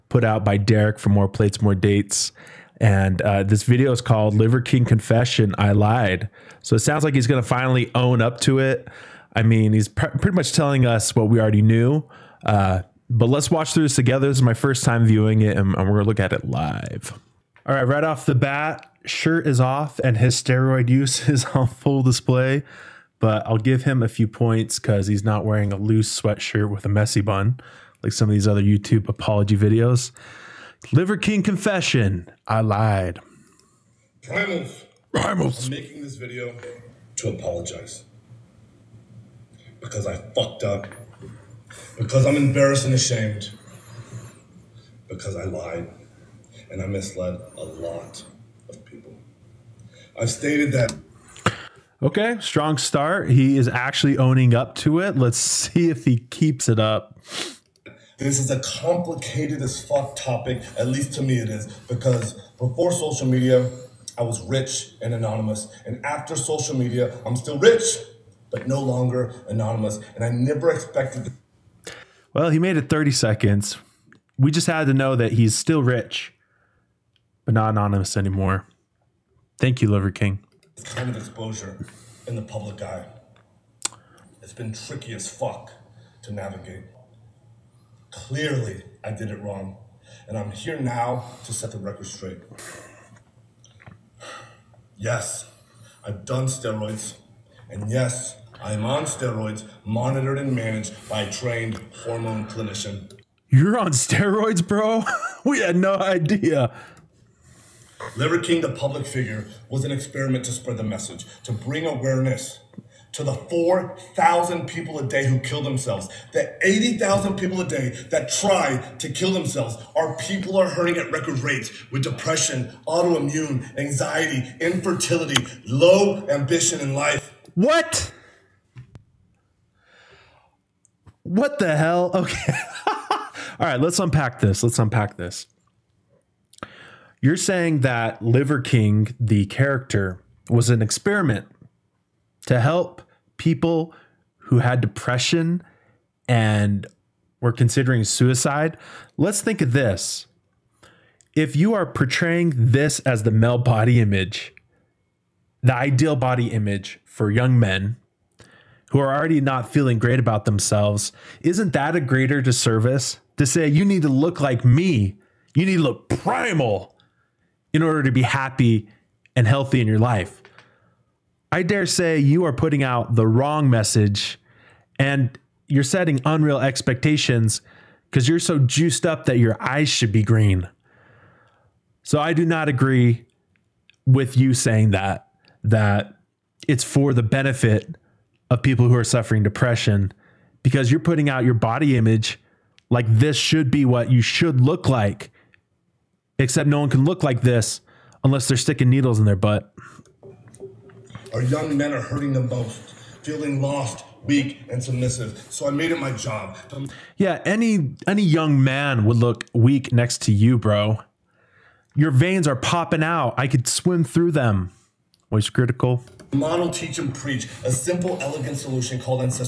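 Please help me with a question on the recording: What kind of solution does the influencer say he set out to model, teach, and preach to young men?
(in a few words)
simple, elegant solution.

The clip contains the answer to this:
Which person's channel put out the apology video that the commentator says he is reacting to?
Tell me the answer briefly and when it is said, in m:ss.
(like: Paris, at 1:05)
Derek, at 0:00.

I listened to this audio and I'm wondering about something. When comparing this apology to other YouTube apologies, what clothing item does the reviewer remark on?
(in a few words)
loose sweatshirt.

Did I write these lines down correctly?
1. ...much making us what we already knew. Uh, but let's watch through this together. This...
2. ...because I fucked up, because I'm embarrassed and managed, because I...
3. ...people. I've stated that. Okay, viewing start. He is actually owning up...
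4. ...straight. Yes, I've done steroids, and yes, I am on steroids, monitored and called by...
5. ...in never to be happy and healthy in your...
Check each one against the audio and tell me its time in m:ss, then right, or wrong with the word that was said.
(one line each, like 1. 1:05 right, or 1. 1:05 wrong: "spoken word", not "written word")
1. 0:10 wrong: "telling", not "making"
2. 0:39 wrong: "ashamed", not "managed"
3. 0:48 wrong: "strong", not "viewing"
4. 1:32 wrong: "managed", not "called"
5. 2:47 wrong: "order", not "never".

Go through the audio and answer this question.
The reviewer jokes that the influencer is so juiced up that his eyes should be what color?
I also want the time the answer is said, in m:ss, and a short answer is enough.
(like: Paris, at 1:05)
green, at 3:00.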